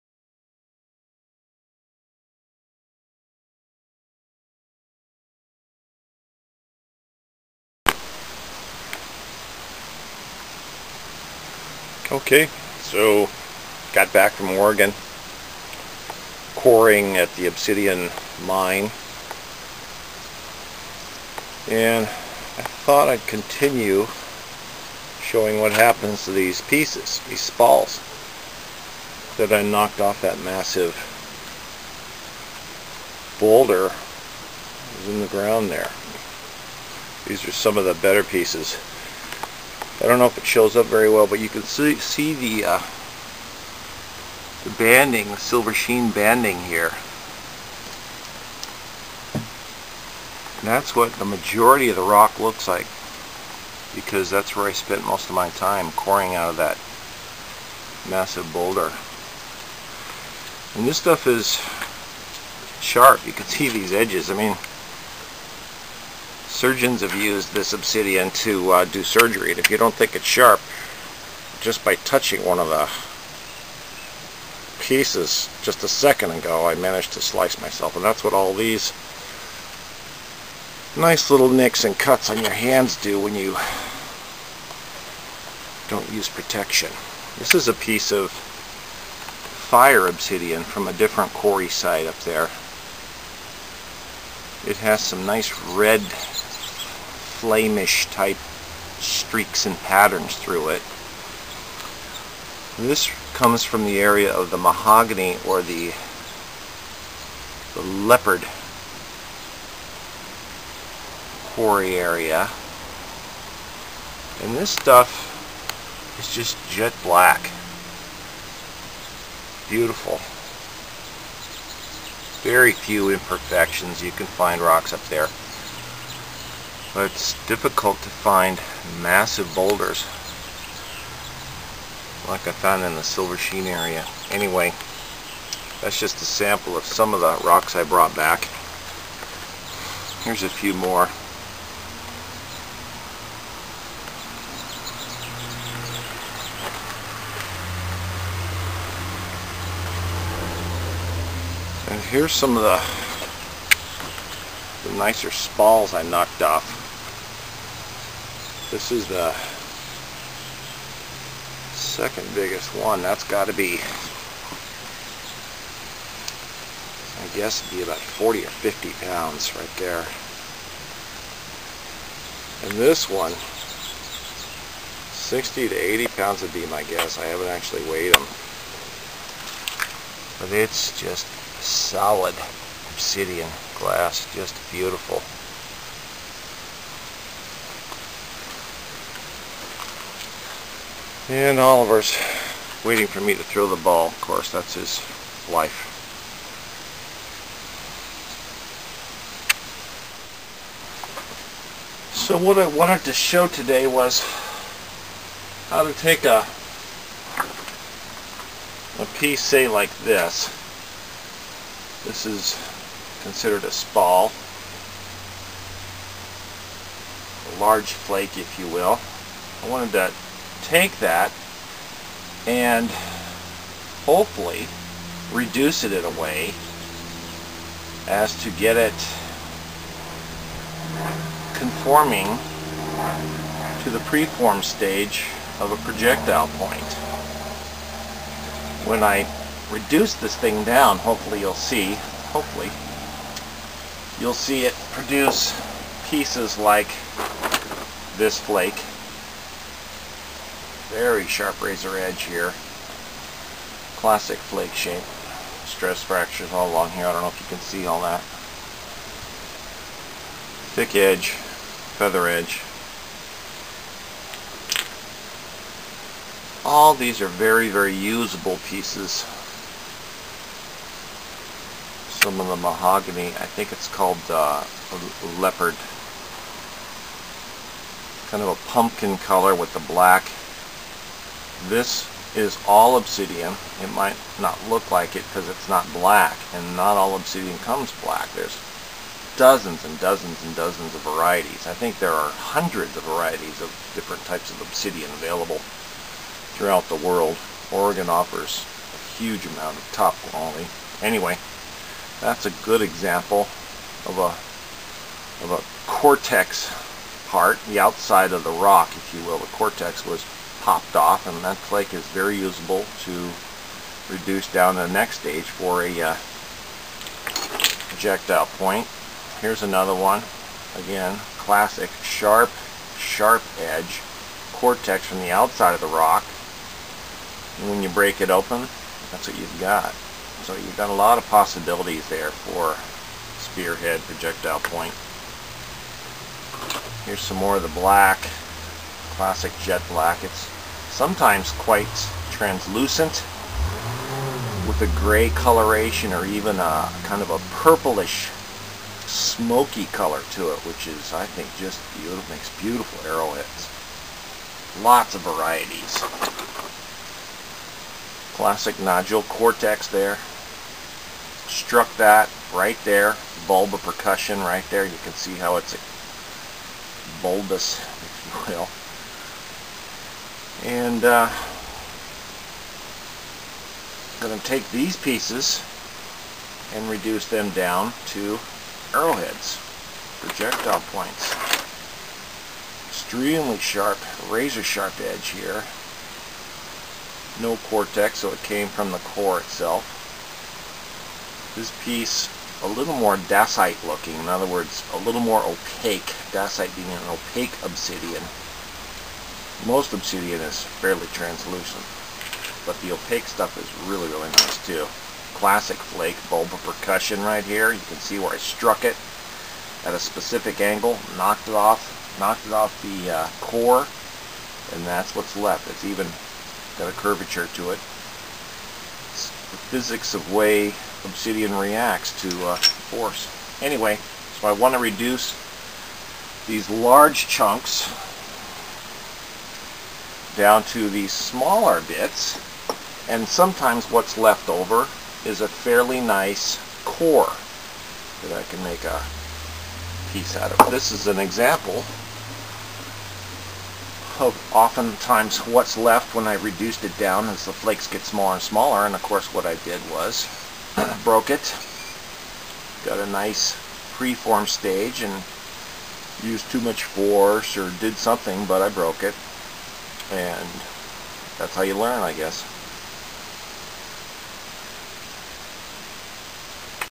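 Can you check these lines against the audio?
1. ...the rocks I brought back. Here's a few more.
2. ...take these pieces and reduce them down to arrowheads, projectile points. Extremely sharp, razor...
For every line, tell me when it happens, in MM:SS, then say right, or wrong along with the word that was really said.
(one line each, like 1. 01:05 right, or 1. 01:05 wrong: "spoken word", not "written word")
1. 02:17 right
2. 06:14 right.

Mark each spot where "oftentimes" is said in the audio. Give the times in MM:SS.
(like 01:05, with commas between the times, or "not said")
07:24.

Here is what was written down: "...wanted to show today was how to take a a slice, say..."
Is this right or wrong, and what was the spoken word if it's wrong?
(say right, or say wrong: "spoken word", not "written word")
wrong: "piece", not "slice".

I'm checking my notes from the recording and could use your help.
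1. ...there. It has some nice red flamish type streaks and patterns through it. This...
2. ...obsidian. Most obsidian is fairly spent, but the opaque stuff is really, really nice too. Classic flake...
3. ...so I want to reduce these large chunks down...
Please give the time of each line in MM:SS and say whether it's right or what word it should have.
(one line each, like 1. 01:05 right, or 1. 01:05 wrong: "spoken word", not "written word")
1. 01:32 right
2. 06:37 wrong: "translucent", not "spent"
3. 07:04 right.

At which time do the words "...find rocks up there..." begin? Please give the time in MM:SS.
02:04.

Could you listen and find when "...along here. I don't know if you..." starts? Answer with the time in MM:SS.
04:16.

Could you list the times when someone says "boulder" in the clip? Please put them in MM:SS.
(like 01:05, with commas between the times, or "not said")
00:33, 00:58, 02:09.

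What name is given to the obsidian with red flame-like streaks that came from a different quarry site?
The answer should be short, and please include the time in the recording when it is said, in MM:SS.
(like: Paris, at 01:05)
Fire obsidian, at 01:28.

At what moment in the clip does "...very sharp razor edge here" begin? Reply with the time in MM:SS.
04:10.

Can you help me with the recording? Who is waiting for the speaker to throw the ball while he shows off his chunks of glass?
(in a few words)
Oliver.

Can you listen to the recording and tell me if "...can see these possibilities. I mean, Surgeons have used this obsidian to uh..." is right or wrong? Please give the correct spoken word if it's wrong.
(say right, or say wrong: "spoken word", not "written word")
wrong: "edges", not "possibilities".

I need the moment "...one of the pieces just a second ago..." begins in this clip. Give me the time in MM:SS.
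01:12.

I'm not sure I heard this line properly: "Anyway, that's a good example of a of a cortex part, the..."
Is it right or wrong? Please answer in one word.
right.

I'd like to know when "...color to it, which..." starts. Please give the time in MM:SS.
05:49.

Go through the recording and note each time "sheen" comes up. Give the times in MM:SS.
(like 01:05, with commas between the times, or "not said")
00:45, 02:13.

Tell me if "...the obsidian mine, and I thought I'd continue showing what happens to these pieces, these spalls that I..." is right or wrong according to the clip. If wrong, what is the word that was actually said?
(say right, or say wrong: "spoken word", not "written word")
right.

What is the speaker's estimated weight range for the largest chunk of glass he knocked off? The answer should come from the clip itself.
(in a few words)
60 to 80 pounds.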